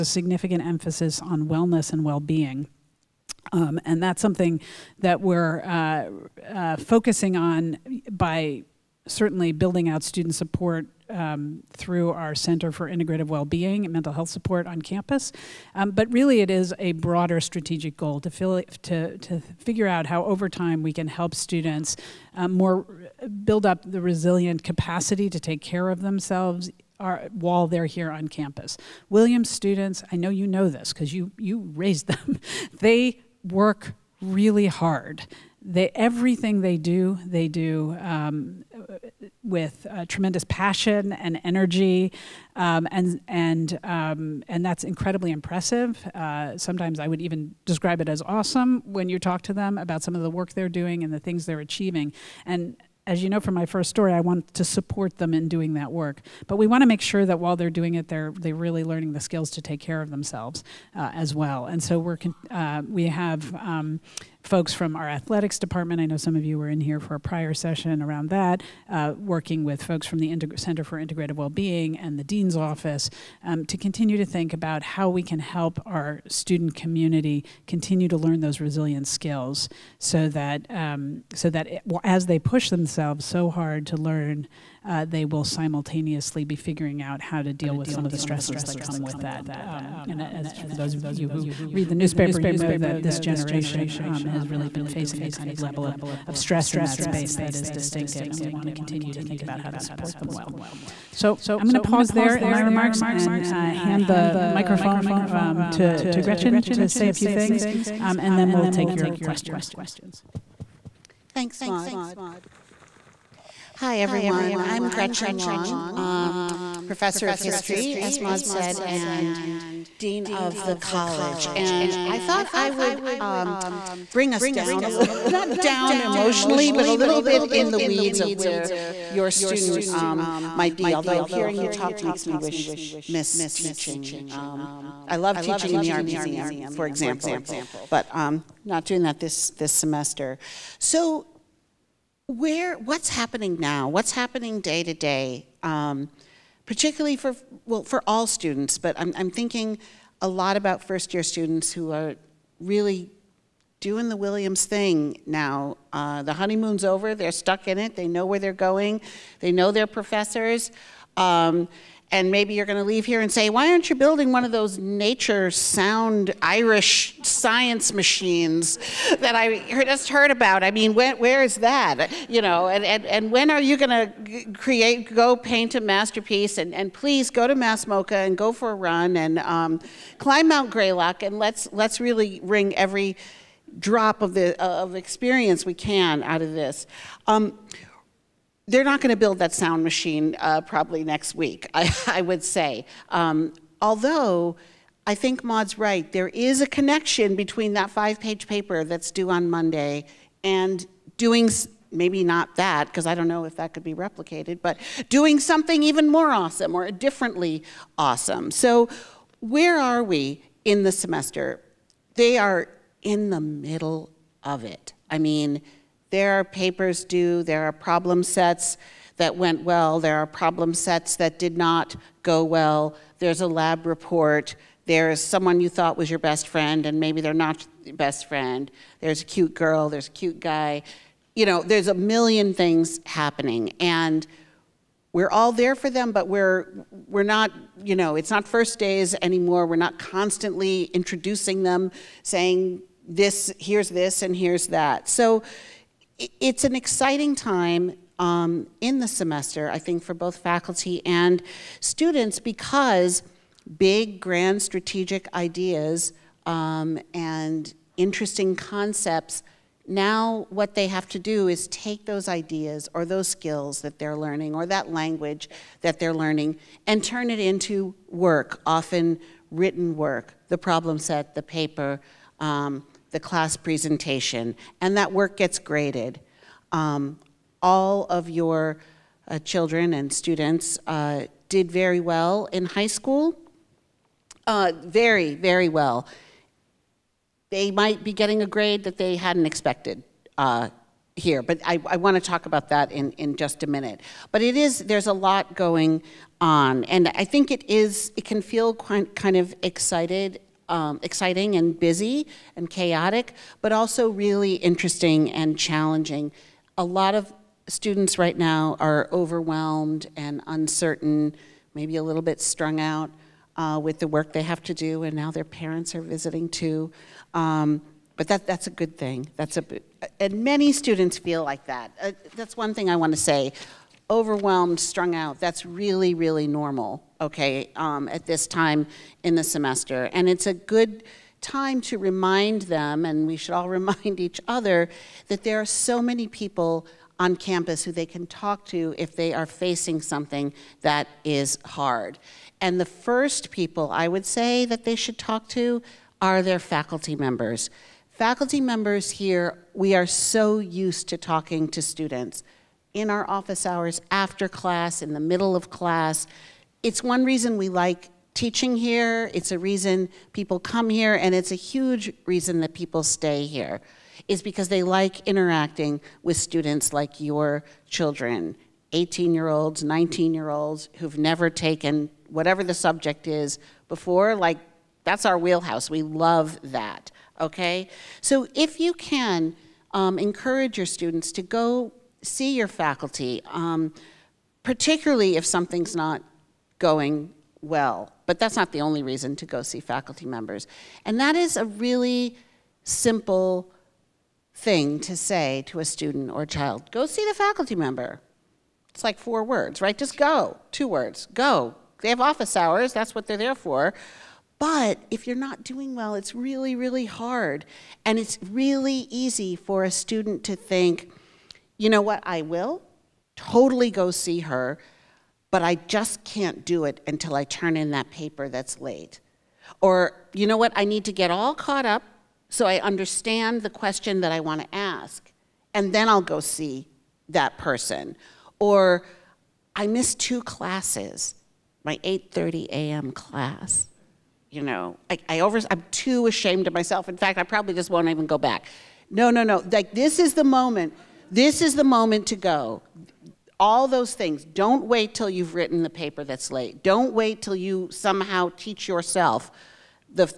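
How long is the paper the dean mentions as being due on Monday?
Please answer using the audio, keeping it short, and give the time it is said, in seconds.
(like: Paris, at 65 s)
5 pages, at 197 s.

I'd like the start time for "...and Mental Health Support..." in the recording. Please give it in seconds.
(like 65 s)
13 s.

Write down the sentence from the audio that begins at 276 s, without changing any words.
Um, all of your uh, children and students uh, did very well in high school.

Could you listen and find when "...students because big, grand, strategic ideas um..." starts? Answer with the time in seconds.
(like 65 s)
251 s.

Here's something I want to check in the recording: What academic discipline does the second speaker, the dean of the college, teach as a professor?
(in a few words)
history.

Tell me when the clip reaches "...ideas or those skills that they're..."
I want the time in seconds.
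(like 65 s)
262 s.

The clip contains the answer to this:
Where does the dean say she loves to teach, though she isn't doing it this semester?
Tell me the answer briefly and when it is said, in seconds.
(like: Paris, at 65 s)
the art museum, at 135 s.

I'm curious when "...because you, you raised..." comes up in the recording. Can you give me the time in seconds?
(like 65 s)
30 s.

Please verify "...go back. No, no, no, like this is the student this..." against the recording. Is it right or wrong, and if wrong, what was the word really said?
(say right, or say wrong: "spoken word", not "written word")
wrong: "moment", not "student".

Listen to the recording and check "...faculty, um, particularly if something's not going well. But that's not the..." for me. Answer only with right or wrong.
right.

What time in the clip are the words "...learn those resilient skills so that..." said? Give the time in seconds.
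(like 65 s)
78 s.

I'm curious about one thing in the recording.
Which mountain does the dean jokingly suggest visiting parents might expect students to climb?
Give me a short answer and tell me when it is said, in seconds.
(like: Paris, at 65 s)
Mount Greylock, at 180 s.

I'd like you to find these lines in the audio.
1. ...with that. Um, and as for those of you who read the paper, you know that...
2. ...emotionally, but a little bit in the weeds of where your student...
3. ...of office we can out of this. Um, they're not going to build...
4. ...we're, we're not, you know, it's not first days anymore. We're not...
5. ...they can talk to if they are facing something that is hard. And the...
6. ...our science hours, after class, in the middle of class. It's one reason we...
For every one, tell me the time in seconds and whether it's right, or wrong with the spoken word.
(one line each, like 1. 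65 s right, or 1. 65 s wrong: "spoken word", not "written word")
1. 89 s wrong: "newspaper", not "paper"
2. 125 s right
3. 184 s wrong: "experience", not "office"
4. 236 s right
5. 337 s right
6. 353 s wrong: "office", not "science".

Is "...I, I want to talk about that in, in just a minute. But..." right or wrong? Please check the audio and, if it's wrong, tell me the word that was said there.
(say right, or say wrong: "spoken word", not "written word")
right.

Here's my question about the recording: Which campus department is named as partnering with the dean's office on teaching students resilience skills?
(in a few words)
athletics department.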